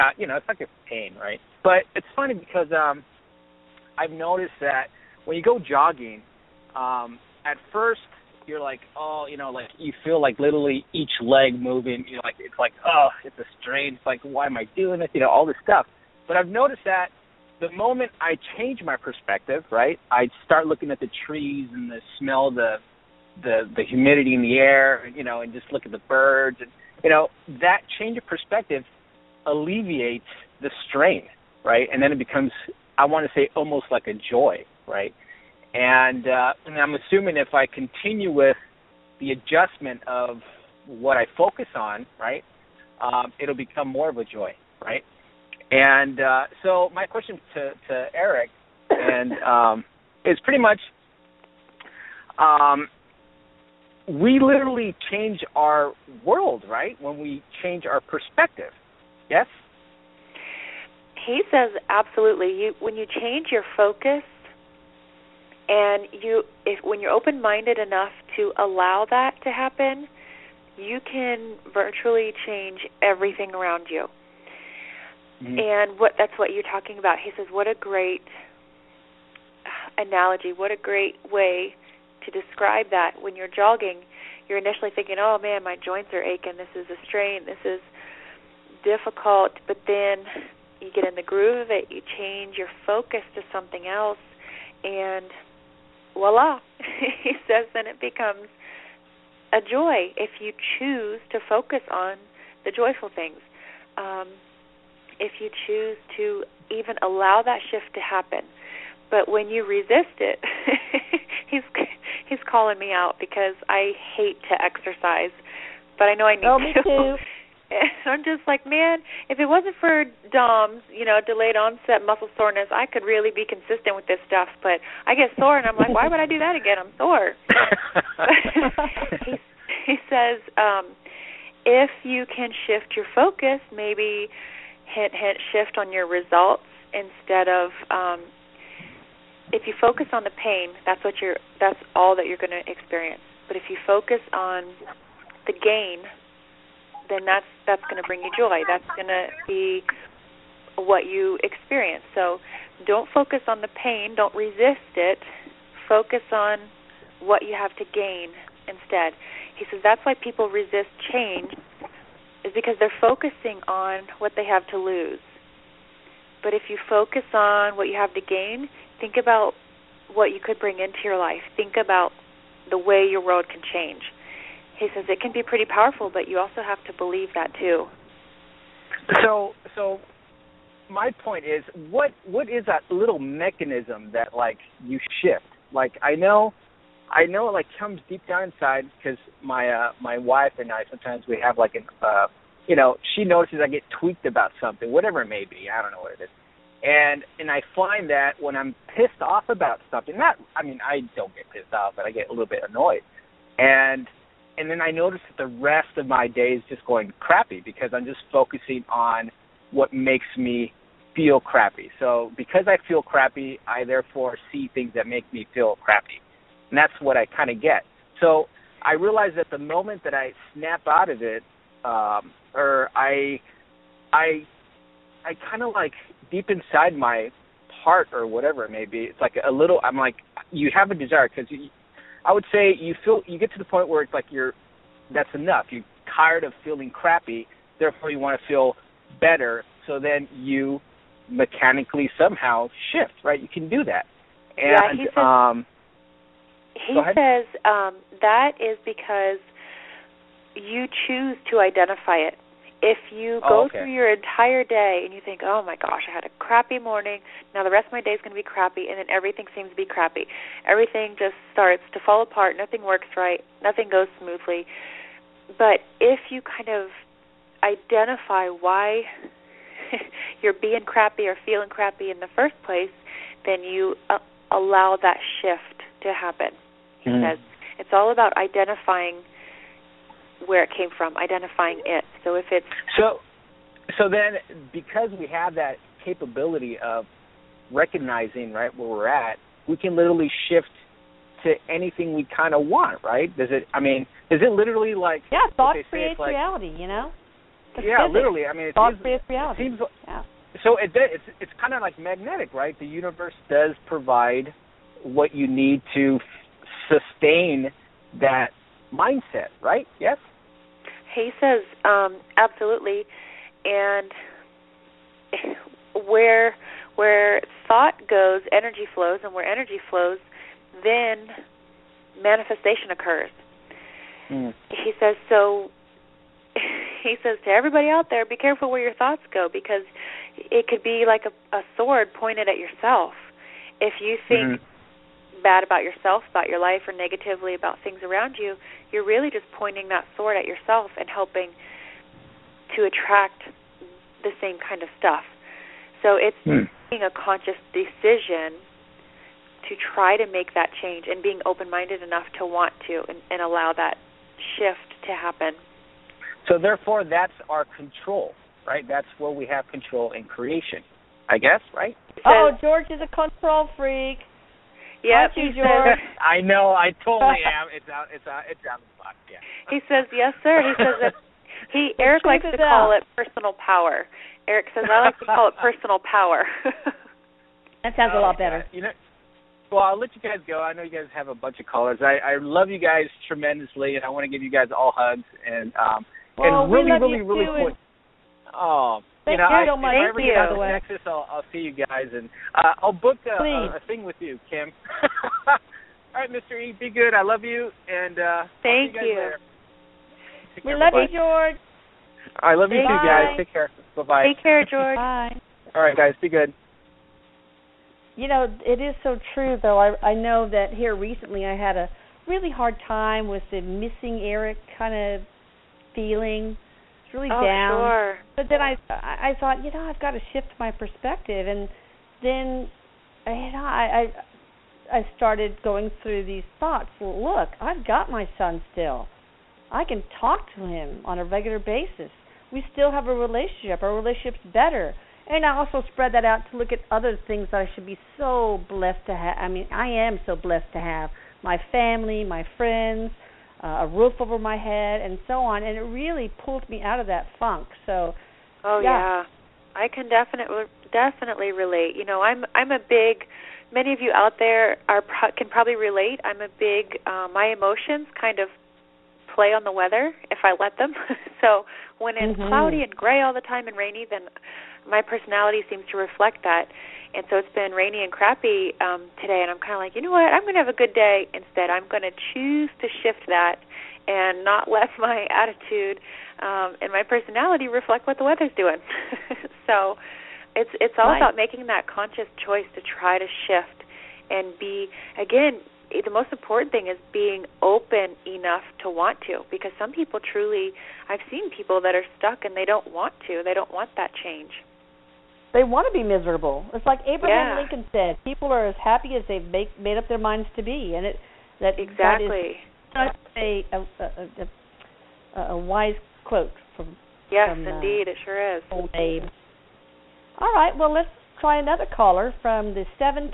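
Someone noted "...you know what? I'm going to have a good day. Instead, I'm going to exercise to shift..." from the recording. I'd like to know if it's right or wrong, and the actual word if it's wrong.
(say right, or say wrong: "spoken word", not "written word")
wrong: "choose", not "exercise".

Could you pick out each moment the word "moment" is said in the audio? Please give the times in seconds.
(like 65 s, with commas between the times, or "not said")
17 s, 219 s.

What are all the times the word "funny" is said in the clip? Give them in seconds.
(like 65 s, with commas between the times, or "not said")
2 s.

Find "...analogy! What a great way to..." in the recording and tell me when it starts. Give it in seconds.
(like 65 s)
80 s.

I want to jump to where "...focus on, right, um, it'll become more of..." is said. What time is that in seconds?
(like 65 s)
41 s.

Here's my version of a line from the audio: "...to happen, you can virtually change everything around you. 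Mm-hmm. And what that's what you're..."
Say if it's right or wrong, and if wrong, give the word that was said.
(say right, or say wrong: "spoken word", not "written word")
right.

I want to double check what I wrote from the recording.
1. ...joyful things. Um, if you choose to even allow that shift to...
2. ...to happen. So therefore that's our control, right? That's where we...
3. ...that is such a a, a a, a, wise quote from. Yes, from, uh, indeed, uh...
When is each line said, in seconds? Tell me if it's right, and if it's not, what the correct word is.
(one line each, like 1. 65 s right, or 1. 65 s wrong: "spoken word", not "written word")
1. 102 s right
2. 355 s right
3. 502 s right.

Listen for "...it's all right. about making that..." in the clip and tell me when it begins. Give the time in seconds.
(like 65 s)
480 s.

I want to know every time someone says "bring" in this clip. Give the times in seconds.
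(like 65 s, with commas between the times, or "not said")
148 s, 170 s.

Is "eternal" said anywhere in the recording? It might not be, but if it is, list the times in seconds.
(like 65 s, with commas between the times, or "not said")
not said.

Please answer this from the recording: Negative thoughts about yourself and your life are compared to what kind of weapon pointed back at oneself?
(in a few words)
a sword.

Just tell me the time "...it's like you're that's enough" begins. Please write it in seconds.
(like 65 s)
234 s.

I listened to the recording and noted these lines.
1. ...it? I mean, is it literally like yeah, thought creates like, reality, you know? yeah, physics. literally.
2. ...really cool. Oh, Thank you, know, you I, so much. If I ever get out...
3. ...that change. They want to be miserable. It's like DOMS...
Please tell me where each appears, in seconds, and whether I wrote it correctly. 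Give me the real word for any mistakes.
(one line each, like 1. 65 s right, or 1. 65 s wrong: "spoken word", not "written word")
1. 293 s right
2. 387 s right
3. 493 s wrong: "Abraham", not "DOMS".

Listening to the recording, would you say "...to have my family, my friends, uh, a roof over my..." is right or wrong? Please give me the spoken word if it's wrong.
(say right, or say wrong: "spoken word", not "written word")
right.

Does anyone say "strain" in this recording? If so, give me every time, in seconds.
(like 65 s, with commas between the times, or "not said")
13 s, 30 s, 87 s.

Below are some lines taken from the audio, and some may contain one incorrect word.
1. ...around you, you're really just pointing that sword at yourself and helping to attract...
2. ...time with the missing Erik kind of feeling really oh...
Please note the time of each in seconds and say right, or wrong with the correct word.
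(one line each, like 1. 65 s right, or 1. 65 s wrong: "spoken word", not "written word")
1. 338 s right
2. 412 s right.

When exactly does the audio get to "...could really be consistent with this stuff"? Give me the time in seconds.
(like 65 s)
122 s.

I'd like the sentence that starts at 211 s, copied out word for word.
So because I feel crappy, I therefore see things that make me feel crappy.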